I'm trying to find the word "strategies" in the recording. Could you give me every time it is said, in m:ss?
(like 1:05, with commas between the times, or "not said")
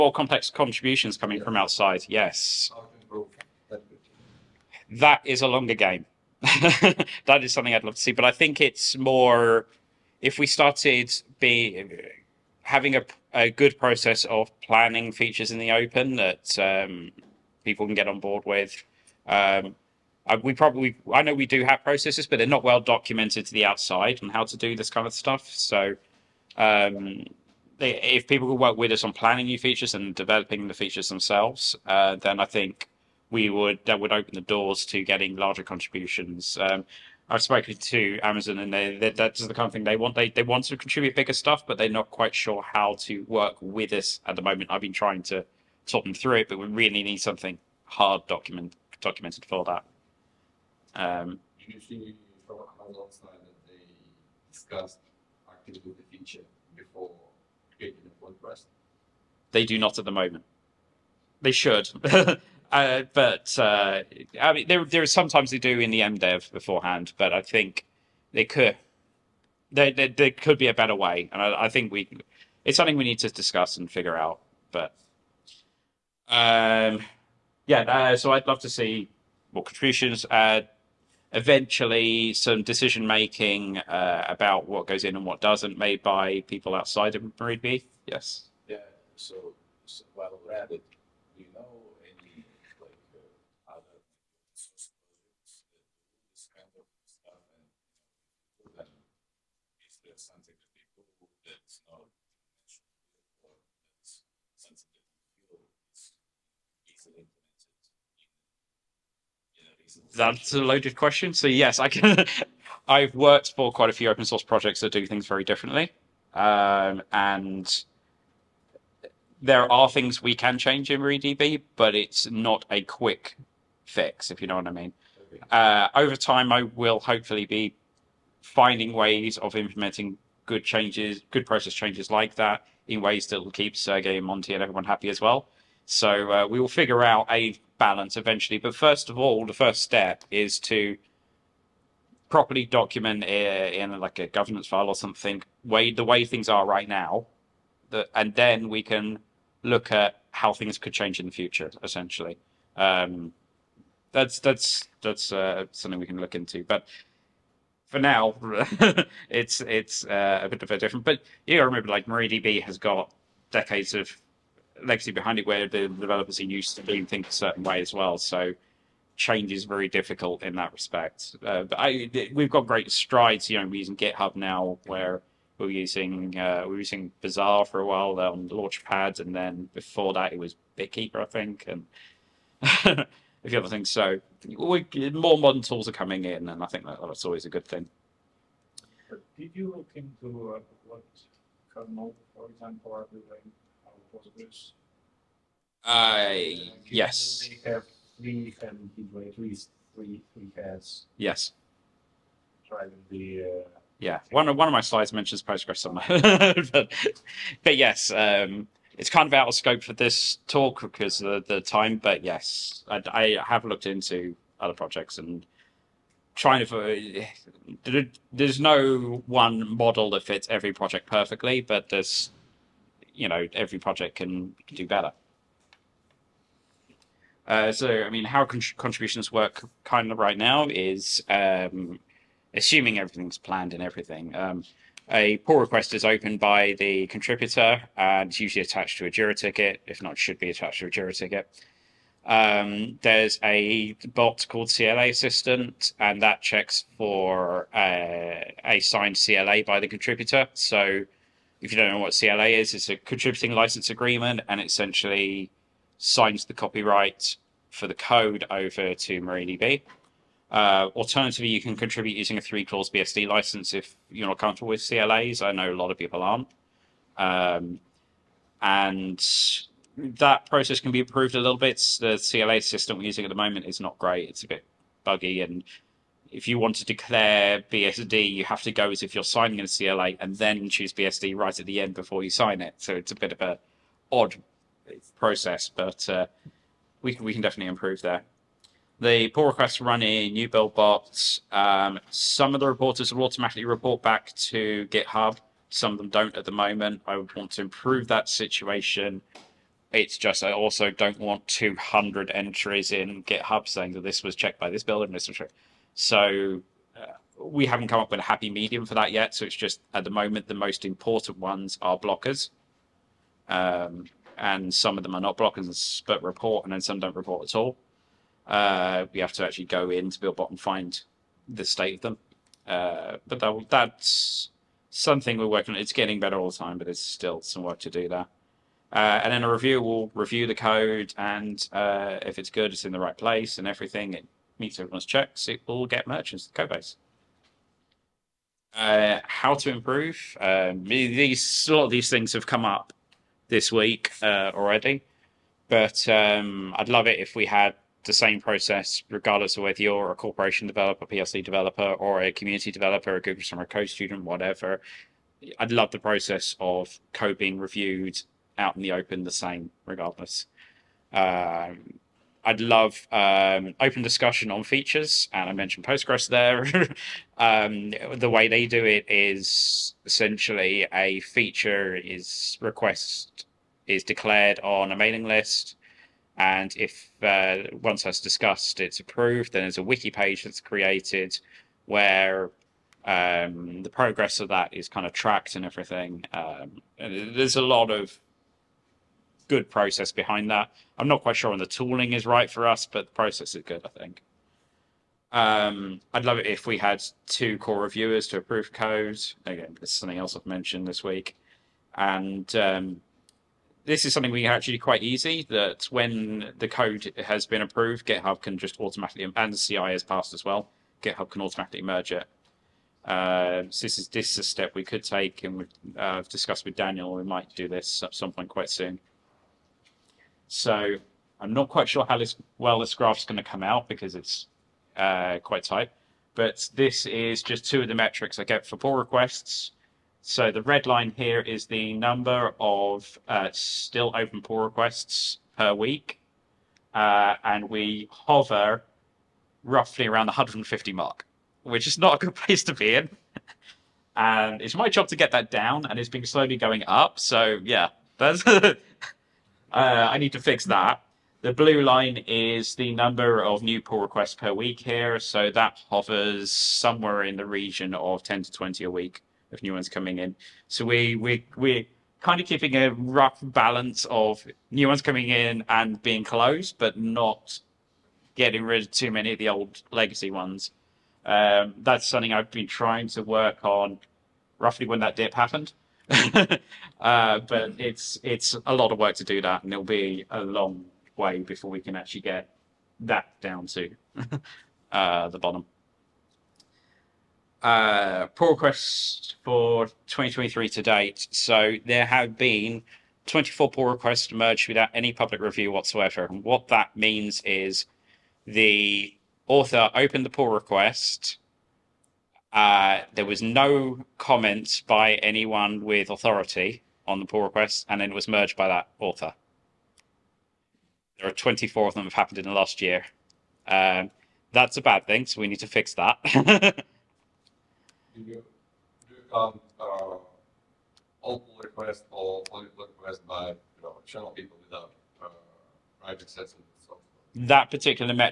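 not said.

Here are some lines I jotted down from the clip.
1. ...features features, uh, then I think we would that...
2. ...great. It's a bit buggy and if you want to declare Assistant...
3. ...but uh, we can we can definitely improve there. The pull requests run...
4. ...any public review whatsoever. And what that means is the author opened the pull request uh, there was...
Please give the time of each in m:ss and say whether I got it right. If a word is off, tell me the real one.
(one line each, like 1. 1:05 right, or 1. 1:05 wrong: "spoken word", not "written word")
1. 0:30 wrong: "themselves", not "features"
2. 4:33 wrong: "BSD", not "Assistant"
3. 4:45 right
4. 8:14 right.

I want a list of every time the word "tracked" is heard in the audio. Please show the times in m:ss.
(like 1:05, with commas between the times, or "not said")
6:25.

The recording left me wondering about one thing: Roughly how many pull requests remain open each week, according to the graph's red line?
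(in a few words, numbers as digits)
150.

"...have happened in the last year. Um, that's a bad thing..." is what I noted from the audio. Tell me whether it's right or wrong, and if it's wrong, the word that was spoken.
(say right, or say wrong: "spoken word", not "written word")
right.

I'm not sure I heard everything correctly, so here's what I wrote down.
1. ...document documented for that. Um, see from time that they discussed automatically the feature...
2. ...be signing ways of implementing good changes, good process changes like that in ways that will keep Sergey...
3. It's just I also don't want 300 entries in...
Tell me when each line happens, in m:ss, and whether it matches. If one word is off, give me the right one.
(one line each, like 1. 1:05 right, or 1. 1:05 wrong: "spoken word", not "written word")
1. 0:48 wrong: "actively", not "automatically"
2. 2:07 wrong: "finding", not "signing"
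3. 4:59 wrong: "200", not "300".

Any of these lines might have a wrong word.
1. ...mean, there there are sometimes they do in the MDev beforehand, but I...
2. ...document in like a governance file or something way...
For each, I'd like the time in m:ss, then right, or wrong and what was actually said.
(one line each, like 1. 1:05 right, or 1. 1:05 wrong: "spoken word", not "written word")
1. 1:04 right
2. 2:22 right.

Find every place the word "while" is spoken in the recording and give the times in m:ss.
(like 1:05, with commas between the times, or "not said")
1:30, 2:57.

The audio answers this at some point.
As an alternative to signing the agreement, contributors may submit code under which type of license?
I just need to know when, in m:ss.
4:22.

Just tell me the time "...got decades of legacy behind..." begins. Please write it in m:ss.
2:42.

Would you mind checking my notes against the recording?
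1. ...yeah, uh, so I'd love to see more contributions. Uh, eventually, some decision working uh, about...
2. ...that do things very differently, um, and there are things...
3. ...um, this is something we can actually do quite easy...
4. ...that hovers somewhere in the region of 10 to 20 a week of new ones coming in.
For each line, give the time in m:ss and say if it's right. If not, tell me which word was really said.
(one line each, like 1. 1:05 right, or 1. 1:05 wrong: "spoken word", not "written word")
1. 1:17 wrong: "making", not "working"
2. 1:54 right
3. 6:42 right
4. 7:35 right.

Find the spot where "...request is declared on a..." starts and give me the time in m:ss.
6:12.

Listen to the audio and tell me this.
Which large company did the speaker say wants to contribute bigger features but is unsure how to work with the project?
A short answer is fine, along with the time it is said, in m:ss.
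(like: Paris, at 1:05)
Amazon, at 0:38.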